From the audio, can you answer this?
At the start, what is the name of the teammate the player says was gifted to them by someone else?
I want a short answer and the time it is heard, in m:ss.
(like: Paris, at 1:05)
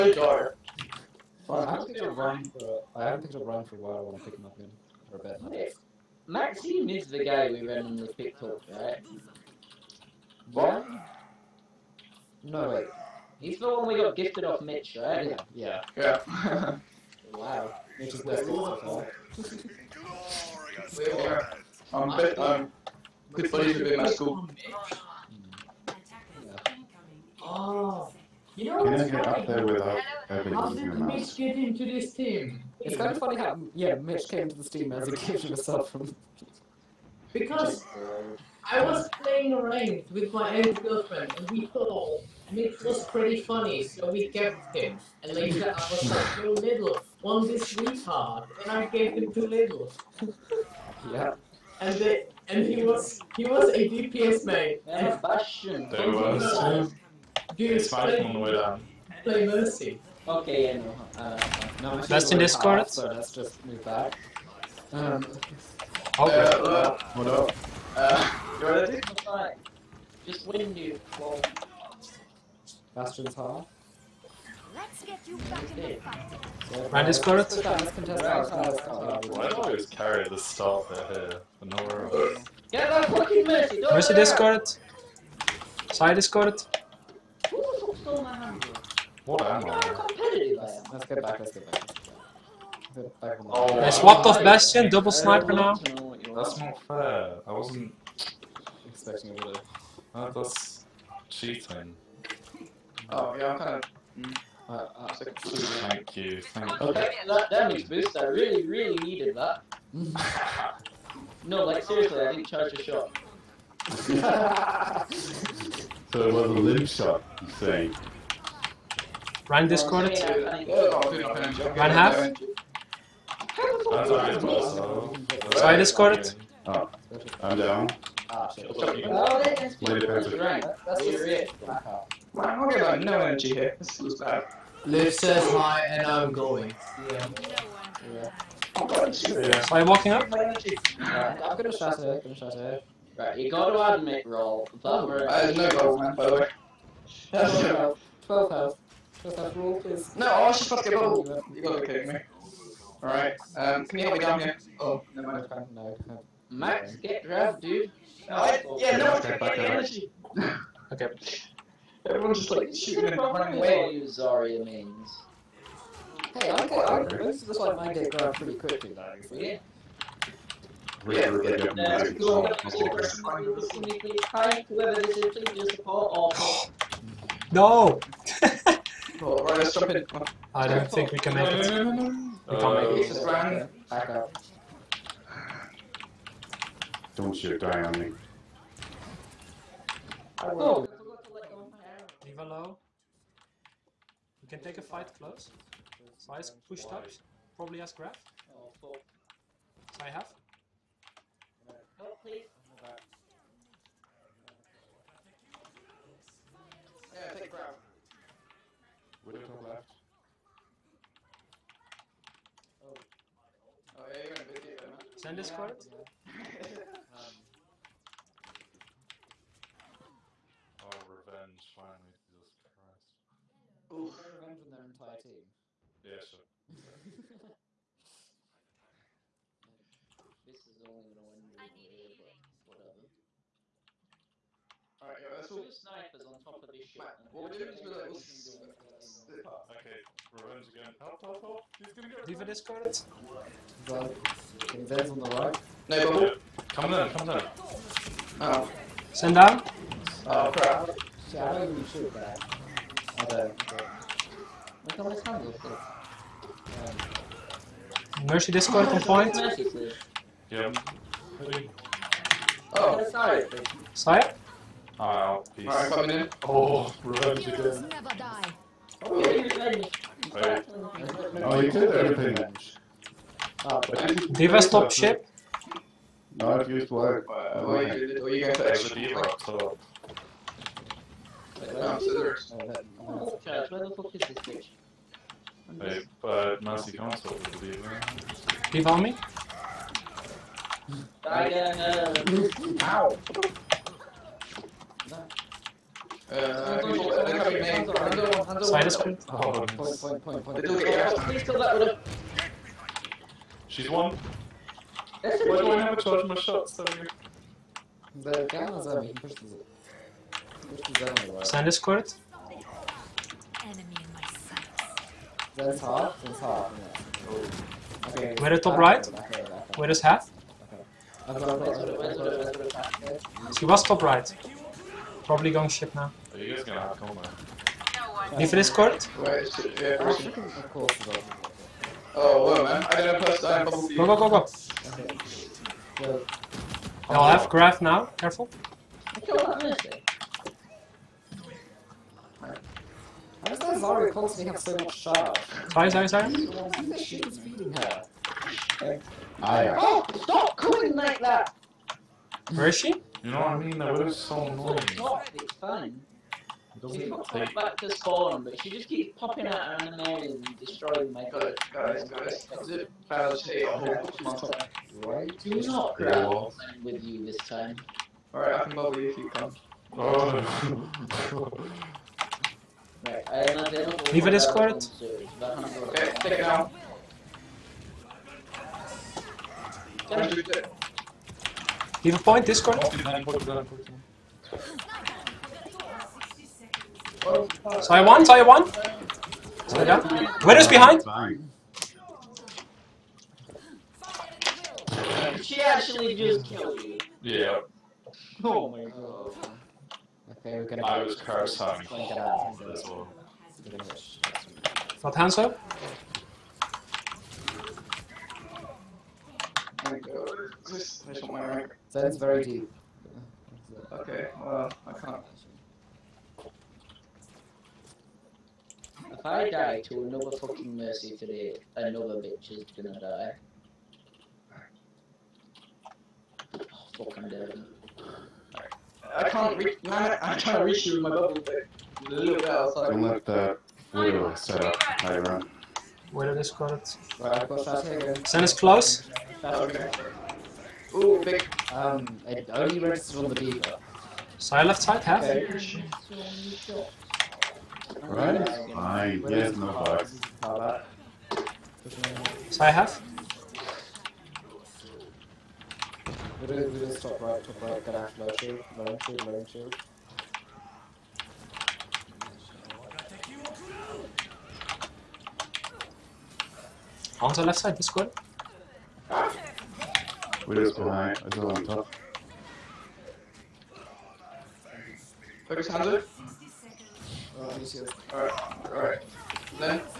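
Maxime, at 0:06.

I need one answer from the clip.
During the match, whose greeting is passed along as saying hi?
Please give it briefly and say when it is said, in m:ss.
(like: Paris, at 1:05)
Liv, at 2:14.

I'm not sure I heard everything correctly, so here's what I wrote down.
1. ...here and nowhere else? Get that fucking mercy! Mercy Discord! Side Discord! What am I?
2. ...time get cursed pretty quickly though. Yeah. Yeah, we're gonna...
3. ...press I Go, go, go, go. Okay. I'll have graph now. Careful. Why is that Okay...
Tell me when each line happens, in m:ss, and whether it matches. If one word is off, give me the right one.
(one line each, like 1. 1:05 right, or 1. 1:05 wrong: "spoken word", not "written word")
1. 1:21 right
2. 2:47 wrong: "grabbed", not "cursed"
3. 5:33 wrong: "Zarya", not "Okay".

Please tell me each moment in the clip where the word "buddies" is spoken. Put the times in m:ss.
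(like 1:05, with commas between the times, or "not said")
0:23.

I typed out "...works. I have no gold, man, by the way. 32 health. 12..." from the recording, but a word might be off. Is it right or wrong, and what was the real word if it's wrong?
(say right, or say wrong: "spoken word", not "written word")
wrong: "12", not "32".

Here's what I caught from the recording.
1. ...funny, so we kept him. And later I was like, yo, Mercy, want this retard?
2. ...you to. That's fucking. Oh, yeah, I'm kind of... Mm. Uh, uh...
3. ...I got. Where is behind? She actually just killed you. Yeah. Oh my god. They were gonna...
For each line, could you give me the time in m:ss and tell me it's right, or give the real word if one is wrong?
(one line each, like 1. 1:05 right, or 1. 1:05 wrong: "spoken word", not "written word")
1. 0:43 wrong: "Little", not "Mercy"
2. 1:39 wrong: "cheating", not "fucking"
3. 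6:29 right.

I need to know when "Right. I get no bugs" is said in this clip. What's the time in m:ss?
7:28.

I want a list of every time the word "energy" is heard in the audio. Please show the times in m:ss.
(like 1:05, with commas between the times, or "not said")
2:13, 2:39.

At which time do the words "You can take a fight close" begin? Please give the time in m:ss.
3:14.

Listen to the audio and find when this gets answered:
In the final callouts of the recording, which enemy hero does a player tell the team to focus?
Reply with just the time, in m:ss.
7:55.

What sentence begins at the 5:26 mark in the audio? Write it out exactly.
Are you guys gonna have coma?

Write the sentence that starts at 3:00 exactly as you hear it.
I don't think we can make it.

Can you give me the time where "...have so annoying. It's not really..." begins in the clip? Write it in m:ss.
5:54.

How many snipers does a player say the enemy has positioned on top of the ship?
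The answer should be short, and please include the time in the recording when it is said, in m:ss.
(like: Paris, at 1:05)
2, at 3:55.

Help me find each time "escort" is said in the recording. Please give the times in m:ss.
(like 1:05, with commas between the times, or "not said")
5:28, 6:14, 6:22.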